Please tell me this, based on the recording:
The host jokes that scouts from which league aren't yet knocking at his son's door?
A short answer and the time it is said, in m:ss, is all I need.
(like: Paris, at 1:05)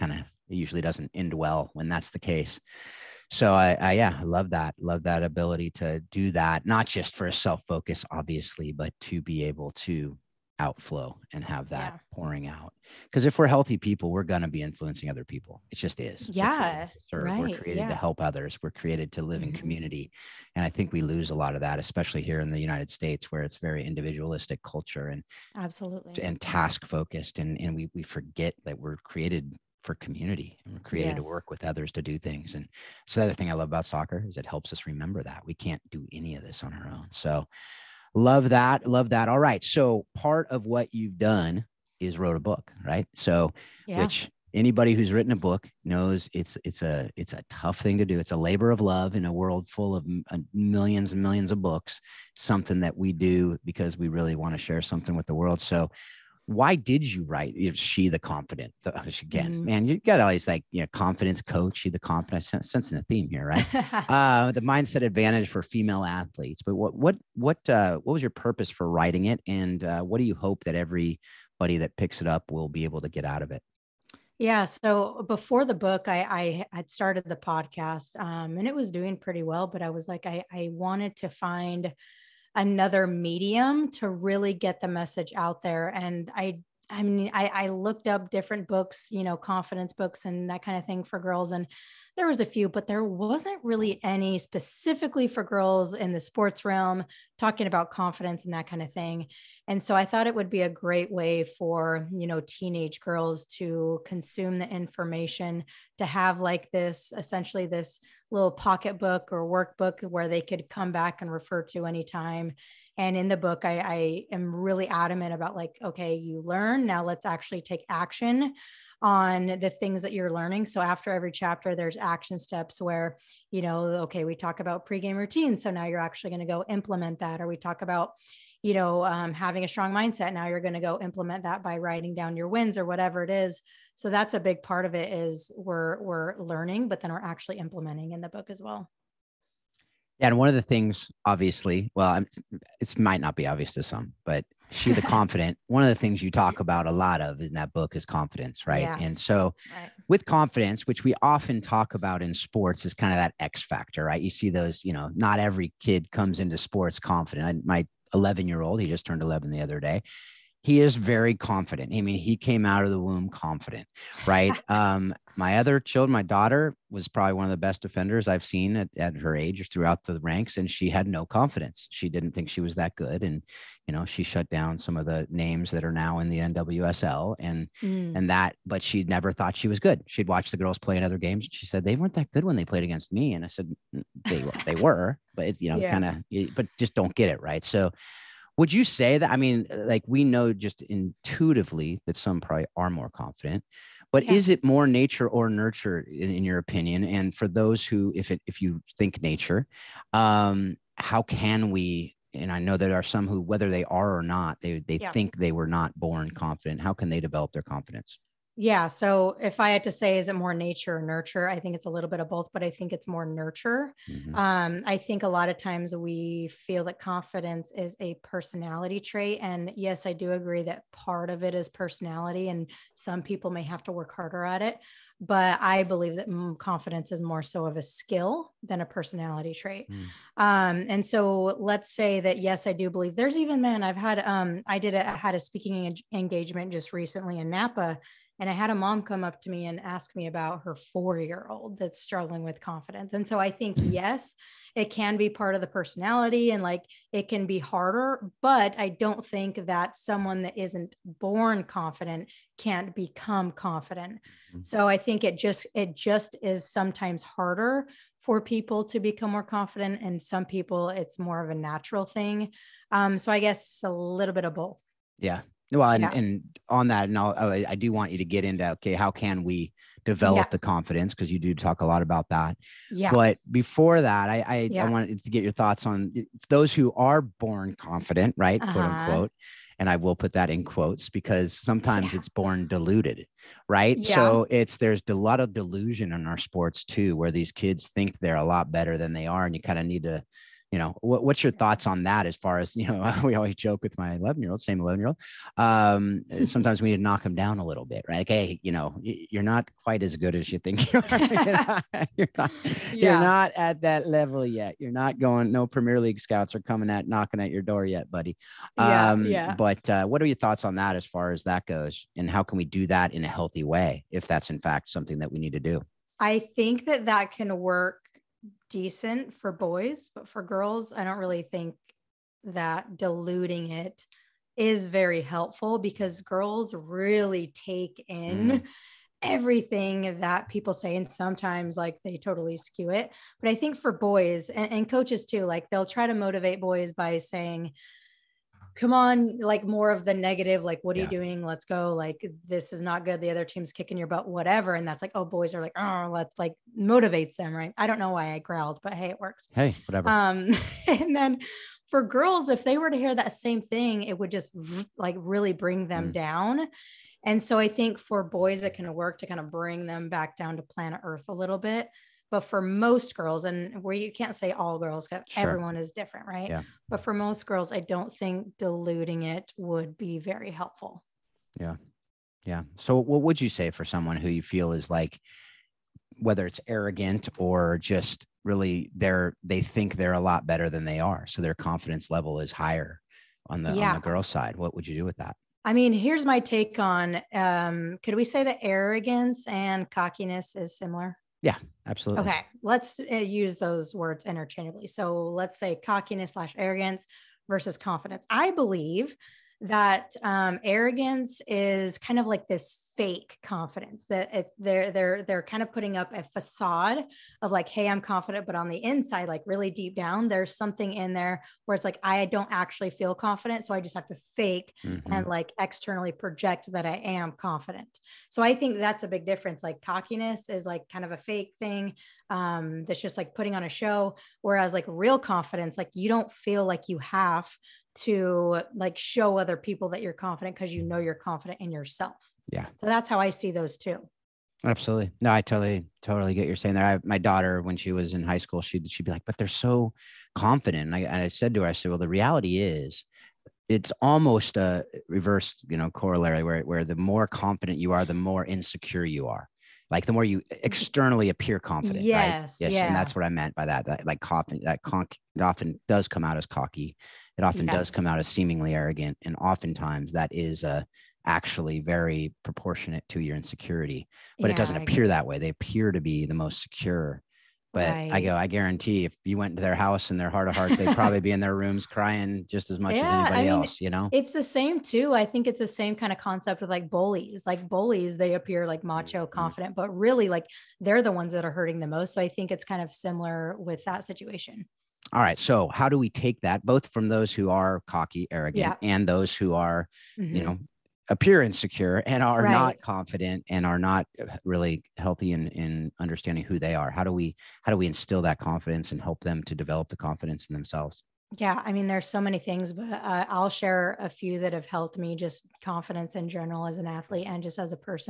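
Premier League, at 5:05.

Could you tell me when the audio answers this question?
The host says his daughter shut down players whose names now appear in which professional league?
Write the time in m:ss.
2:56.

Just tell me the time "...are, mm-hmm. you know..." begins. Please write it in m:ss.
8:09.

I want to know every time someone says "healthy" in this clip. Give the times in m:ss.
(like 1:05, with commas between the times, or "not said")
0:13, 5:13, 8:14.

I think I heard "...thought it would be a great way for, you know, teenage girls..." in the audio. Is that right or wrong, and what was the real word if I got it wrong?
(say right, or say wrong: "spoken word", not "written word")
right.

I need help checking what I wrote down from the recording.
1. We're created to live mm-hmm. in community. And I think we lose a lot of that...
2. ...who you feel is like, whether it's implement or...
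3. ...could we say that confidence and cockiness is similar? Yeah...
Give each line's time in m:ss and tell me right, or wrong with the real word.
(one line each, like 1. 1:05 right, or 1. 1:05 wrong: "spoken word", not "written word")
1. 0:18 right
2. 6:14 wrong: "arrogant", not "implement"
3. 6:28 wrong: "arrogance", not "confidence".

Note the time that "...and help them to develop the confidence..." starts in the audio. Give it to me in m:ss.
8:18.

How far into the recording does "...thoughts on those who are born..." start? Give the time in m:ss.
4:35.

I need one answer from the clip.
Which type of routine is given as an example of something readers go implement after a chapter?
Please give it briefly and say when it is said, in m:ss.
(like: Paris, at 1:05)
pregame routine, at 2:04.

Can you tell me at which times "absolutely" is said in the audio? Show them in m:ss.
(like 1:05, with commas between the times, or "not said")
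0:25, 6:31, 7:14.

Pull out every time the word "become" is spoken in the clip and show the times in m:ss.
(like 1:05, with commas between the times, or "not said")
4:12, 4:18.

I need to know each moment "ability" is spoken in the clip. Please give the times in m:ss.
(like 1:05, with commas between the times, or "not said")
0:05.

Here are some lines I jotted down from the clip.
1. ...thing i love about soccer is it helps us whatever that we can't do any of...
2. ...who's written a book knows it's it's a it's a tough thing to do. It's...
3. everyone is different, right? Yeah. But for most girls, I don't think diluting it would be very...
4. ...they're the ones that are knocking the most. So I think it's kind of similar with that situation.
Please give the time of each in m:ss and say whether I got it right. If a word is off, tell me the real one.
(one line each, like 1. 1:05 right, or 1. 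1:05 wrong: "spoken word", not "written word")
1. 0:33 wrong: "remember", not "whatever"
2. 0:44 right
3. 6:05 right
4. 8:00 wrong: "hurting", not "knocking".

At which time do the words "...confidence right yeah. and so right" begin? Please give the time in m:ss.
2:28.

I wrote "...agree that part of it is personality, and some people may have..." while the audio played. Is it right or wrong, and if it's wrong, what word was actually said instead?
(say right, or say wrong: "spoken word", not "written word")
right.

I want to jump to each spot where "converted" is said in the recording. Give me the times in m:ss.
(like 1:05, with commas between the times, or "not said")
not said.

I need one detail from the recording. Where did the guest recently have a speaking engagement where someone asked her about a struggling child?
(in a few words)
Napa.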